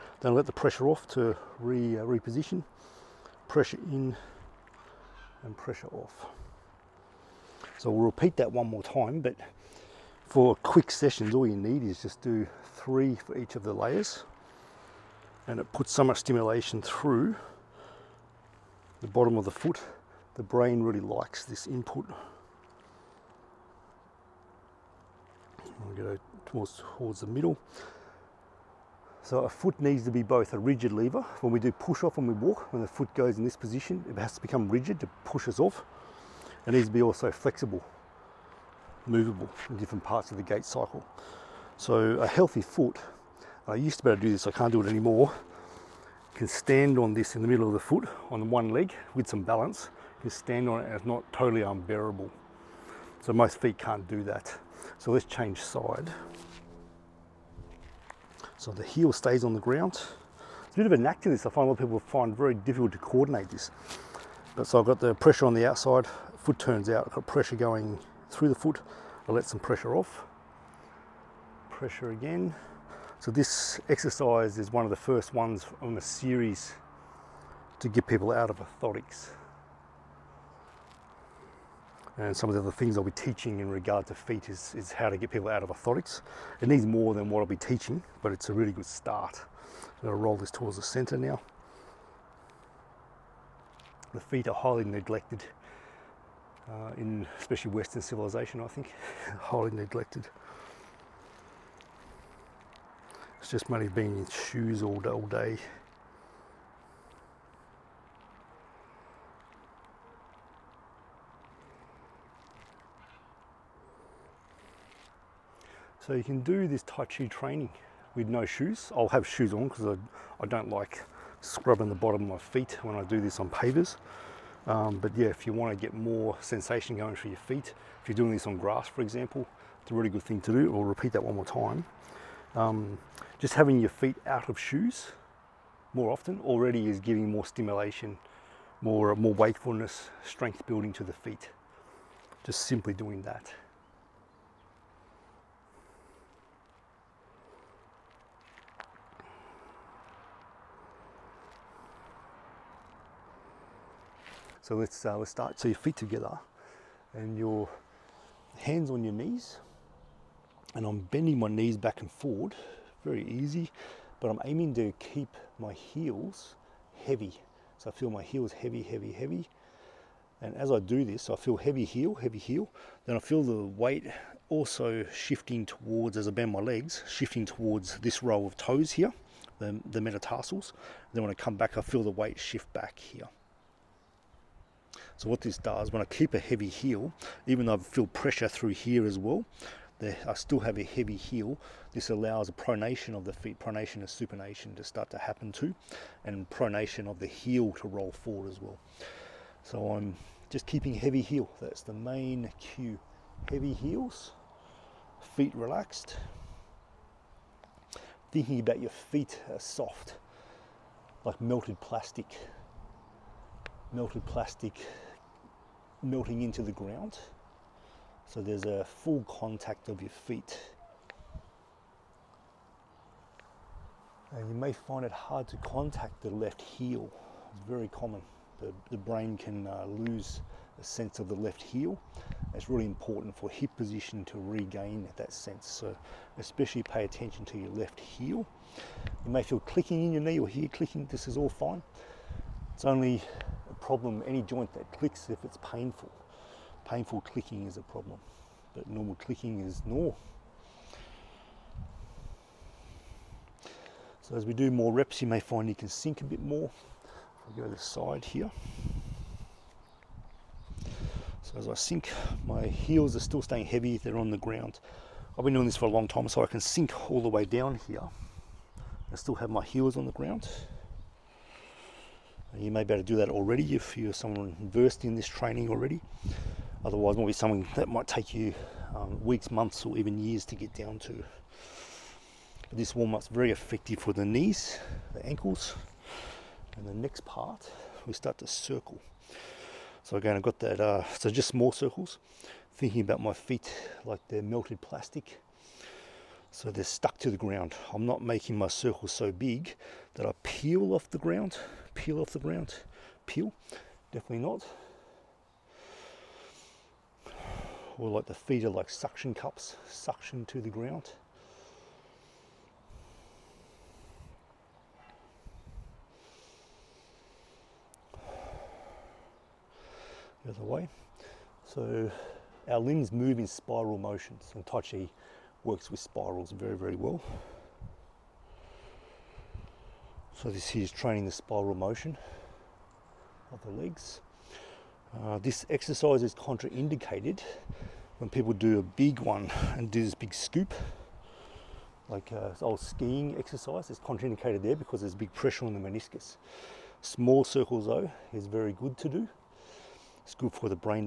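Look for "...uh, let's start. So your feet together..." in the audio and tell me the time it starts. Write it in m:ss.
2:35.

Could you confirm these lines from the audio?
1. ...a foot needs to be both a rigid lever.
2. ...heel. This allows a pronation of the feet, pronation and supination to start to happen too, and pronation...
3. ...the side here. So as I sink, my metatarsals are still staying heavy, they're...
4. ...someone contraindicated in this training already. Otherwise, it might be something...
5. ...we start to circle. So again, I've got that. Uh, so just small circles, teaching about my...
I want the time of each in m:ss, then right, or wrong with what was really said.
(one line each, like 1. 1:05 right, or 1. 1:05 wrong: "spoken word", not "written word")
1. 0:29 right
2. 3:11 right
3. 4:17 wrong: "heels", not "metatarsals"
4. 4:34 wrong: "versed", not "contraindicated"
5. 4:48 wrong: "thinking", not "teaching".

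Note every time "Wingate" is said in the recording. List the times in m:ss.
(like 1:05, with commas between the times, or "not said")
not said.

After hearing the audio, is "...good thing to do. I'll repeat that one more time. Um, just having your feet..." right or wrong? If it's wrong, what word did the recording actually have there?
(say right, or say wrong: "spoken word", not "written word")
right.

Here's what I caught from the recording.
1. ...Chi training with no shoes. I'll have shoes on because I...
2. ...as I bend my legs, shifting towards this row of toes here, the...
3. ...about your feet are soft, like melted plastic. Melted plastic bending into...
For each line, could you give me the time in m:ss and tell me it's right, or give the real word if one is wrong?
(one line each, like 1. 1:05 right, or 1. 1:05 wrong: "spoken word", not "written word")
1. 1:57 right
2. 2:56 right
3. 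3:28 wrong: "melting", not "bending".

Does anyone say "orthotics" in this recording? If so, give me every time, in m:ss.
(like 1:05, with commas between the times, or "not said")
1:18, 1:25.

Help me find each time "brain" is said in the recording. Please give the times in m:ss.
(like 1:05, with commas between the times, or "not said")
0:20, 3:48.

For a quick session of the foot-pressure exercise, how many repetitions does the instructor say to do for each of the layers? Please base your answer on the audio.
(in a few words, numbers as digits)
3.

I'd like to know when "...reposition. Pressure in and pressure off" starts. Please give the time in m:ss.
0:02.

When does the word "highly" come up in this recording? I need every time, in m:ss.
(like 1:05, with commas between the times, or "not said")
1:34, 1:39.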